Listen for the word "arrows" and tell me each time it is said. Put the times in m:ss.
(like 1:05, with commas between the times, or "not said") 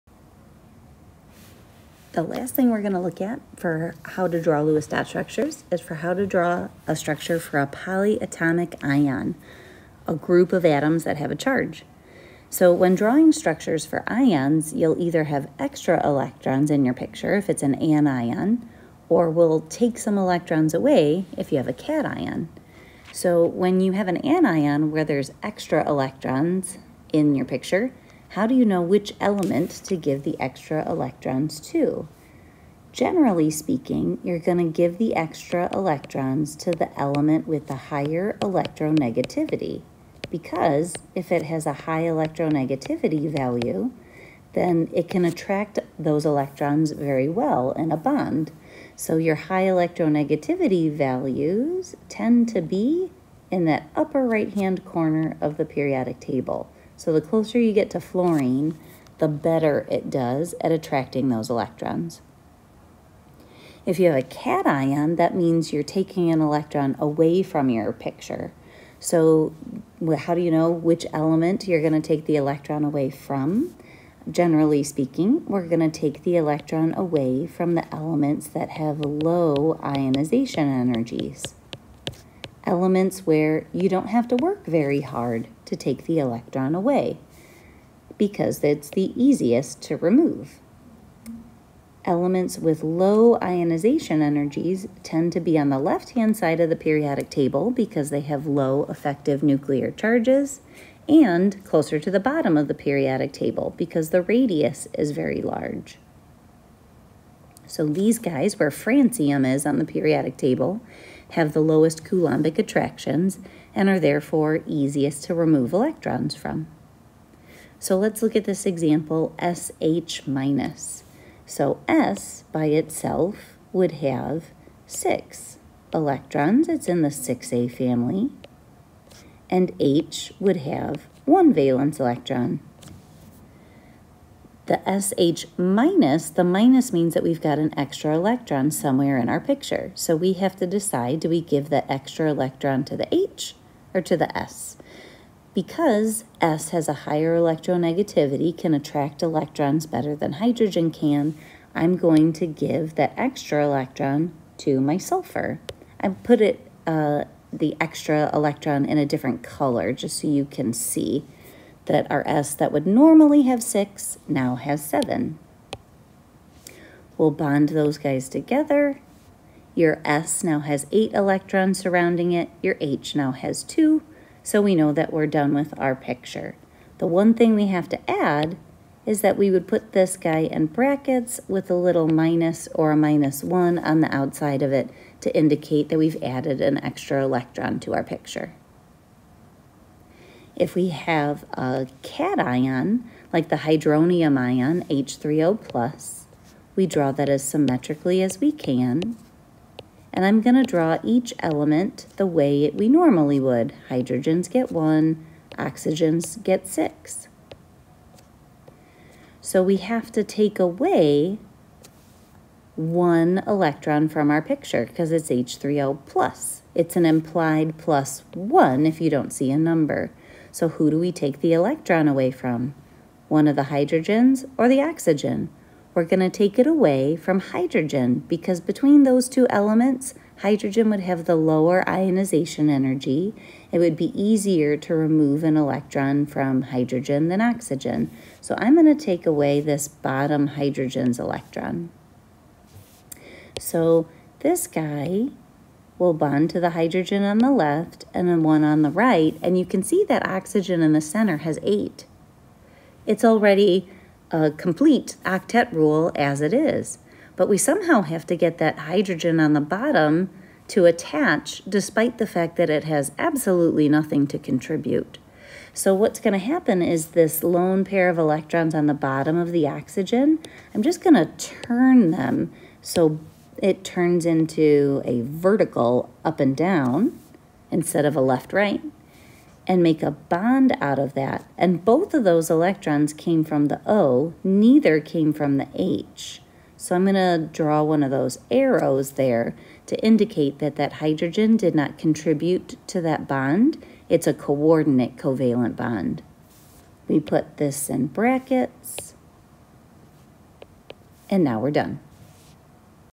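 4:48.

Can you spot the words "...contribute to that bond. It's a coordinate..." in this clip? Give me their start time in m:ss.
4:51.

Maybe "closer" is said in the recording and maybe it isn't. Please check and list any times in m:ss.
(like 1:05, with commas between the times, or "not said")
0:57, 1:41.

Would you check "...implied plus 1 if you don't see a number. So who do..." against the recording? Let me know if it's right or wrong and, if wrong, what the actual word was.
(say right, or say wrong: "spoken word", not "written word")
right.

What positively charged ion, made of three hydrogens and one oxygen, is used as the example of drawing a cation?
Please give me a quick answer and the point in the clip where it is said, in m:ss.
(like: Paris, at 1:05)
Hydronium ion, at 3:13.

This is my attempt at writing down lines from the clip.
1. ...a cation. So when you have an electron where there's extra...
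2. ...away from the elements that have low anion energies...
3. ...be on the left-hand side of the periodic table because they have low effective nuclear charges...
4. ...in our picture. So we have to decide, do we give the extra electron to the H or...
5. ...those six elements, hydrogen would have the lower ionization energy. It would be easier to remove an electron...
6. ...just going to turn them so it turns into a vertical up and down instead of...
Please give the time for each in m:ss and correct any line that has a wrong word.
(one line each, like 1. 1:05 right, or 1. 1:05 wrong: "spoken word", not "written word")
1. 0:21 wrong: "anion", not "electron"
2. 1:16 wrong: "ionization", not "anion"
3. 1:35 right
4. 2:19 right
5. 3:49 wrong: "two", not "six"
6. 4:30 right.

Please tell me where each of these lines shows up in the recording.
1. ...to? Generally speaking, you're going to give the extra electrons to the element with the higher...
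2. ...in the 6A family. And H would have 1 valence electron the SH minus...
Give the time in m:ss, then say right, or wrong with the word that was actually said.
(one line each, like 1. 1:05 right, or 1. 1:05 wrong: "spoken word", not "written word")
1. 0:31 right
2. 2:06 right.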